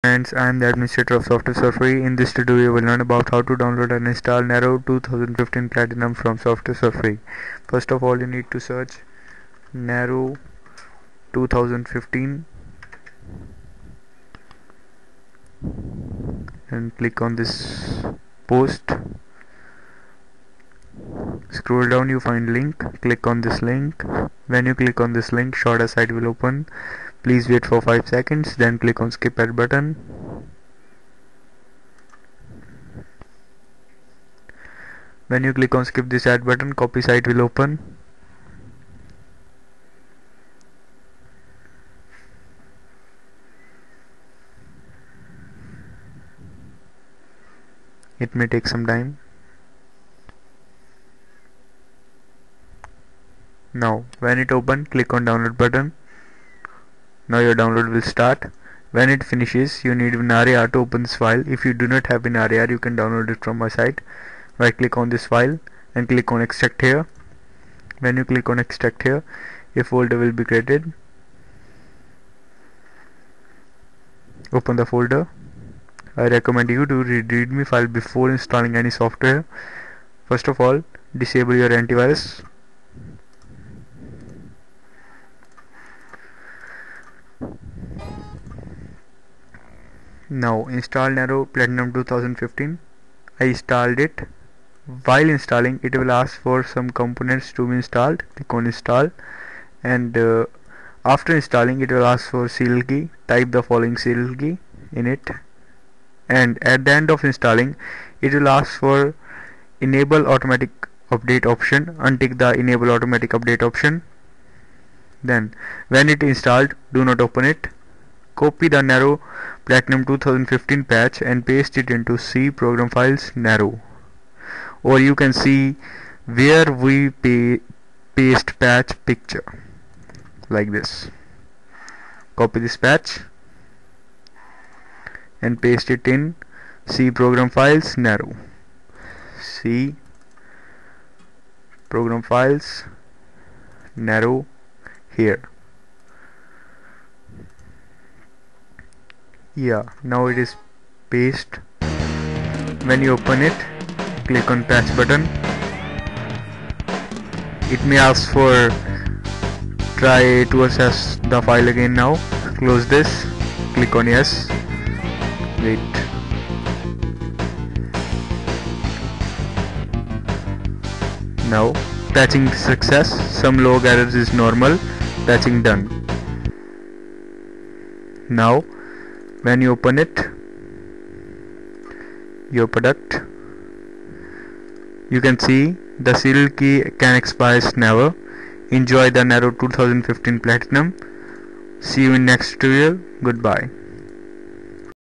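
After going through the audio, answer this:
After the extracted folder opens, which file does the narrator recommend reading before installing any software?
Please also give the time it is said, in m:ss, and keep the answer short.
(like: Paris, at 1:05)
readme file, at 1:17.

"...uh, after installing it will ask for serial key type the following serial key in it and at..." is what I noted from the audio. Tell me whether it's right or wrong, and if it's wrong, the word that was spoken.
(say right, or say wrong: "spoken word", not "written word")
right.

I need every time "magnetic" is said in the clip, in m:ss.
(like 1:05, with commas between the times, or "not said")
not said.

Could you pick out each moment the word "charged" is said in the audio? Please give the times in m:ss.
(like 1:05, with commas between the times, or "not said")
not said.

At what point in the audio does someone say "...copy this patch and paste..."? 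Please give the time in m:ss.
2:12.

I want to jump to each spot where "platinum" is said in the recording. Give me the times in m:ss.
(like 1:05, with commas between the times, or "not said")
0:05, 1:31, 1:59, 3:10.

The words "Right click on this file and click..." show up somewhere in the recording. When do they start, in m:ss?
1:04.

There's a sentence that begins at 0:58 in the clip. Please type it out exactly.
When it finishes, you need WinRAR to open this file.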